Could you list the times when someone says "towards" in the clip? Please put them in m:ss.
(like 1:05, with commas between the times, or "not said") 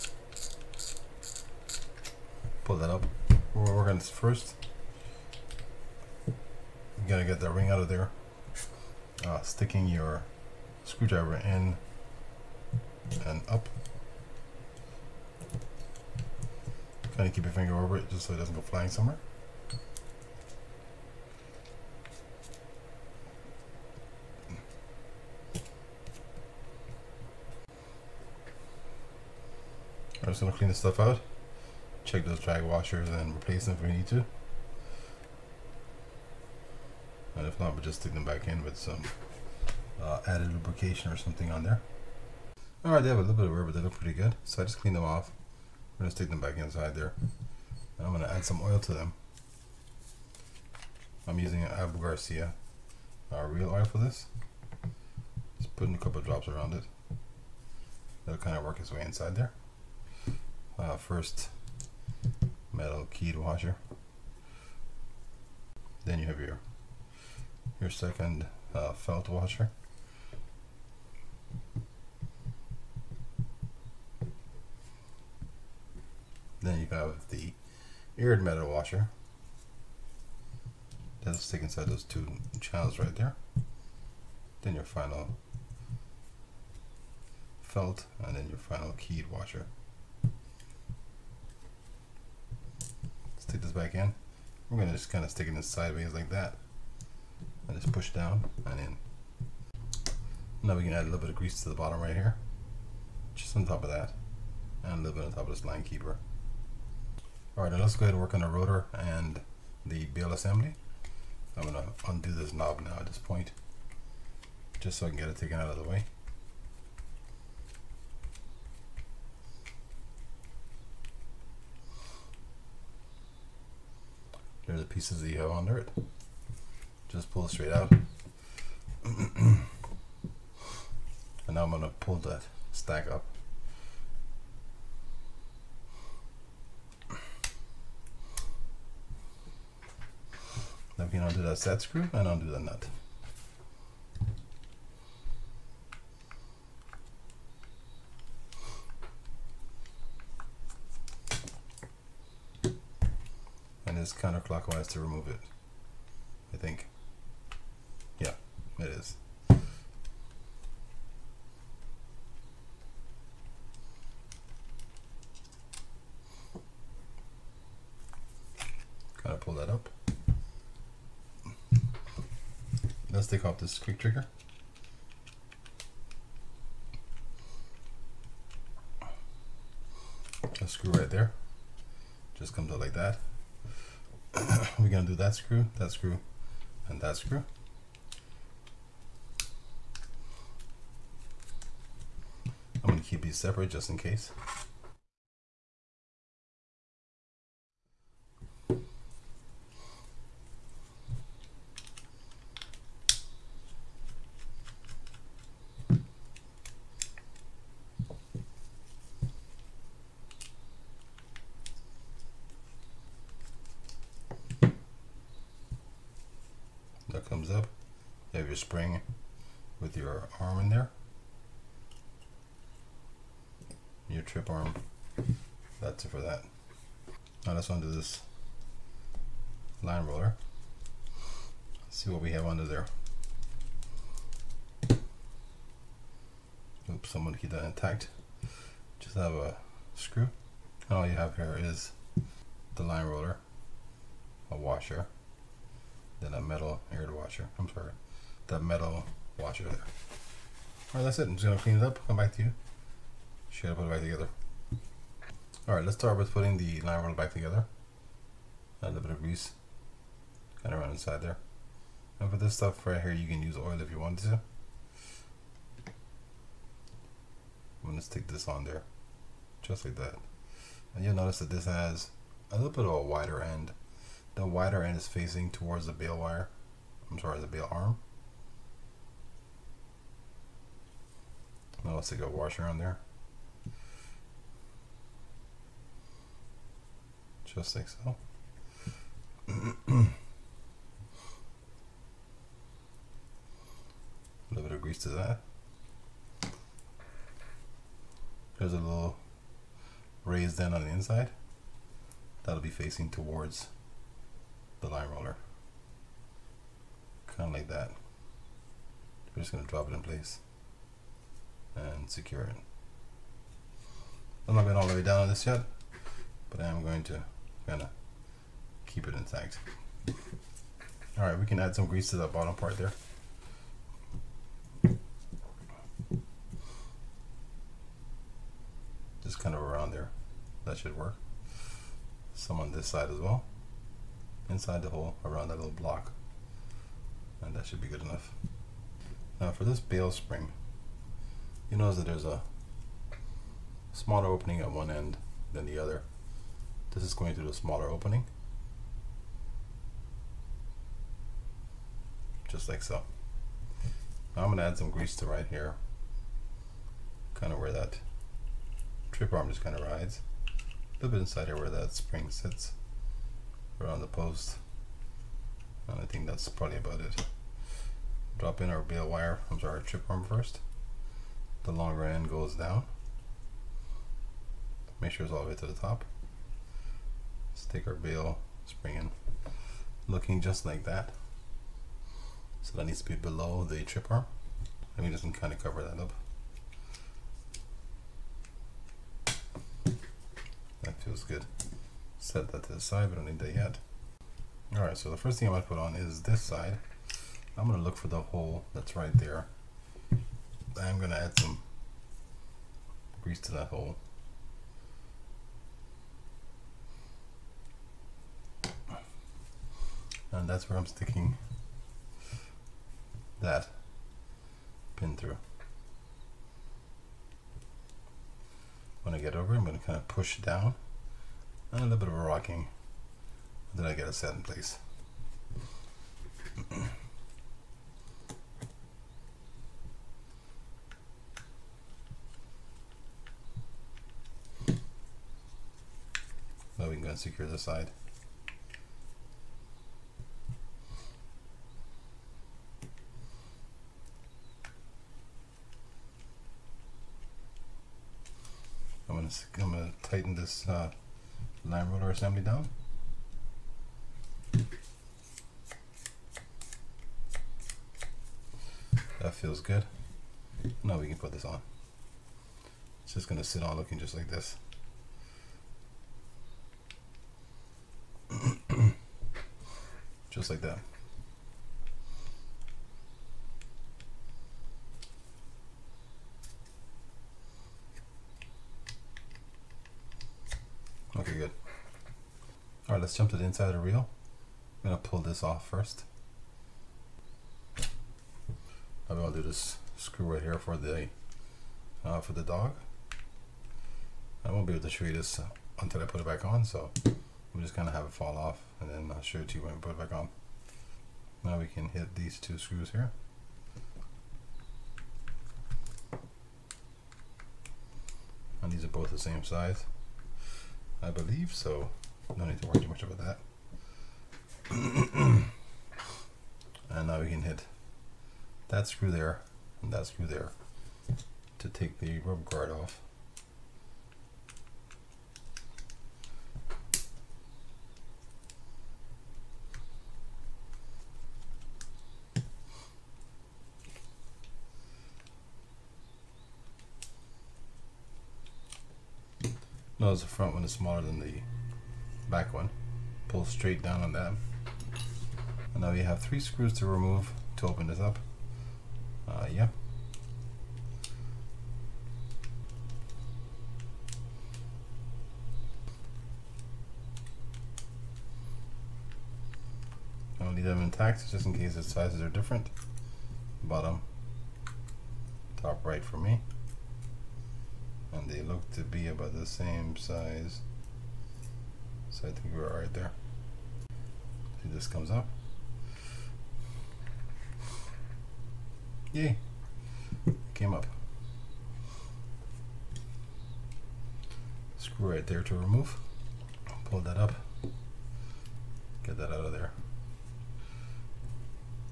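4:35, 5:03.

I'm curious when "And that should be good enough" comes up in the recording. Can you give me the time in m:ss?
5:37.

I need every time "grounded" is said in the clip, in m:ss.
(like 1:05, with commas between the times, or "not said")
not said.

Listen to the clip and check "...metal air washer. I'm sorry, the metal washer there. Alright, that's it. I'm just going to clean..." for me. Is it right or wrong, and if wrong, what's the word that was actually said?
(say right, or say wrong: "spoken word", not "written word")
right.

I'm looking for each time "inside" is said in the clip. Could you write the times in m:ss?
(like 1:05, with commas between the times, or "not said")
0:46, 0:59, 1:21, 4:20, 5:00, 5:34, 6:01, 8:03.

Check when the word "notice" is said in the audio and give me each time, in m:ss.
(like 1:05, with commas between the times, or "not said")
4:31, 5:41, 9:00.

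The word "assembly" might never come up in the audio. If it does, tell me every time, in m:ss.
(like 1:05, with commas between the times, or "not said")
1:50, 7:32.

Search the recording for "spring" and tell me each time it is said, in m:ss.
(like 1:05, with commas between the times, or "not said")
3:38, 5:40, 6:01, 6:18.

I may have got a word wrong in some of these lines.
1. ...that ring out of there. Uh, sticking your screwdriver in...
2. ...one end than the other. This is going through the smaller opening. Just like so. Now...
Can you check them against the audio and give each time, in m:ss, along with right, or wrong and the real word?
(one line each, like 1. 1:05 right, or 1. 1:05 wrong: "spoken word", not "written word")
1. 0:07 right
2. 5:44 right.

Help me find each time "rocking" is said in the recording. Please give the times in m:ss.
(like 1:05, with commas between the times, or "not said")
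7:02.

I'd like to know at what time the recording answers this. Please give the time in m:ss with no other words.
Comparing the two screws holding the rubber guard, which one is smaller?
9:00.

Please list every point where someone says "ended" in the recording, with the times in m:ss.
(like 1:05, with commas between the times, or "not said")
not said.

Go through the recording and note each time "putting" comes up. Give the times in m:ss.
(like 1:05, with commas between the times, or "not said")
0:55, 4:16.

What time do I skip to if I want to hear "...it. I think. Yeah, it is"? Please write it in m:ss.
2:35.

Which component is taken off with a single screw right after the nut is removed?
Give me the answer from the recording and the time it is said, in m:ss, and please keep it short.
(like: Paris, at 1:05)
quick trigger, at 2:53.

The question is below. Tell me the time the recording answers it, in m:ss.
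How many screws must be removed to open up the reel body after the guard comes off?
9:06.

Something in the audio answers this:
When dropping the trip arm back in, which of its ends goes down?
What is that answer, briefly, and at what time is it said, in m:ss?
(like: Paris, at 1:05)
longer end, at 6:11.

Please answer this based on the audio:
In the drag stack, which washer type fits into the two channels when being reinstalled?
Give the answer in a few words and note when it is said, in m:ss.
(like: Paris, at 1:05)
eared metal washer, at 1:18.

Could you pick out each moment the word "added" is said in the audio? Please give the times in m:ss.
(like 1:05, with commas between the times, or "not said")
0:40.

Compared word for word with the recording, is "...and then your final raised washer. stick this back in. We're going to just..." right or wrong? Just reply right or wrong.
wrong.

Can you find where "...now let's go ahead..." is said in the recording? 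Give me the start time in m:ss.
1:47.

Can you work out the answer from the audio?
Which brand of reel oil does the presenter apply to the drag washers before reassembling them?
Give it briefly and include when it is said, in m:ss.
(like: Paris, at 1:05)
Abu Garcia, at 0:51.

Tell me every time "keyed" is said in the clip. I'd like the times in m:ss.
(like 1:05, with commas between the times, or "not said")
1:03, 1:28.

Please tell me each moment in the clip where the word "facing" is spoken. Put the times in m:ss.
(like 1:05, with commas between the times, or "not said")
4:35, 5:02.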